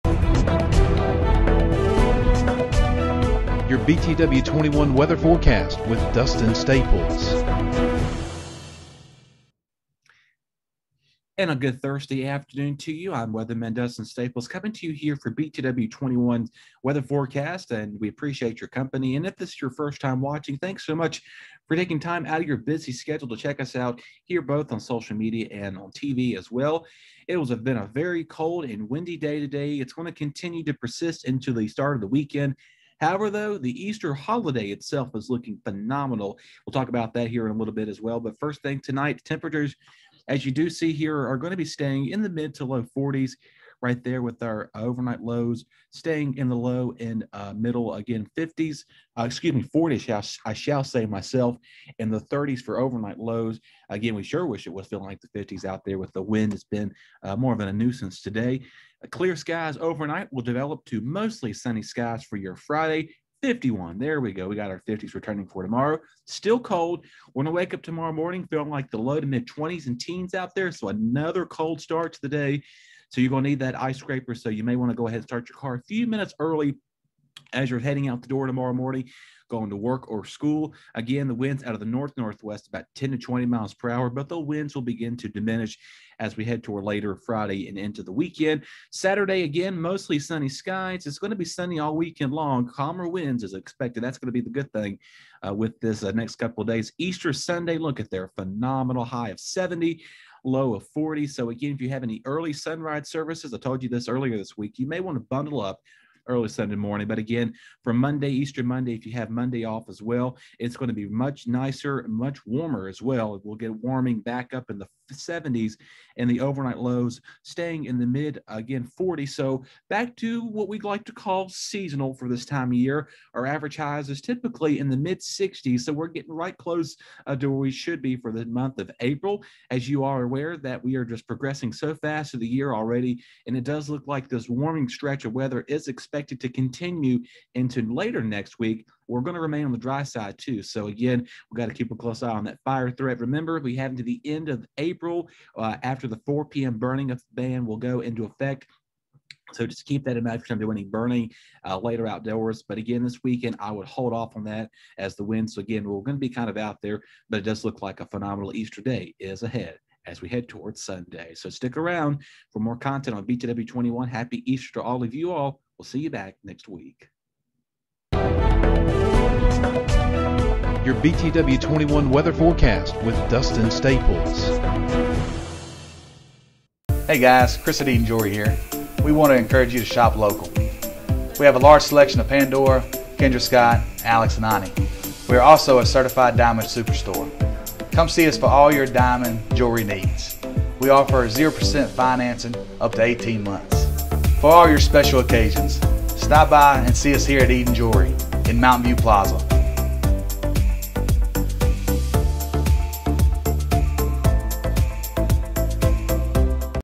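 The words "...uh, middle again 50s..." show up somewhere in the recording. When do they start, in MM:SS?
00:47.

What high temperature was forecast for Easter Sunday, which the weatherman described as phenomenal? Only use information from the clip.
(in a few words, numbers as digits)
70.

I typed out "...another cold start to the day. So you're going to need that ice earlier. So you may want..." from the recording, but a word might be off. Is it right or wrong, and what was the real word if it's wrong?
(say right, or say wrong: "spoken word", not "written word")
wrong: "scraper", not "earlier".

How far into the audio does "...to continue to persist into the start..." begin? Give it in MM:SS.
00:30.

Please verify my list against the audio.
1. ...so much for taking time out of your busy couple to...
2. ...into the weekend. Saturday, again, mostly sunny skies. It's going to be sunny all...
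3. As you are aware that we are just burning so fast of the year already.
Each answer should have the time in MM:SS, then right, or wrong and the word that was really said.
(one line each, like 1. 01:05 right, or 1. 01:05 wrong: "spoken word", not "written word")
1. 00:20 wrong: "schedule", not "couple"
2. 01:27 right
3. 02:09 wrong: "progressing", not "burning".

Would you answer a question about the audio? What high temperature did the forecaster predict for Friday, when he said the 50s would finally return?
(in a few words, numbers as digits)
51.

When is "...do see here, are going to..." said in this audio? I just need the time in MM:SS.
00:40.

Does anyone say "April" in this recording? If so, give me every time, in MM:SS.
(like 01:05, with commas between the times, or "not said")
02:08, 02:24.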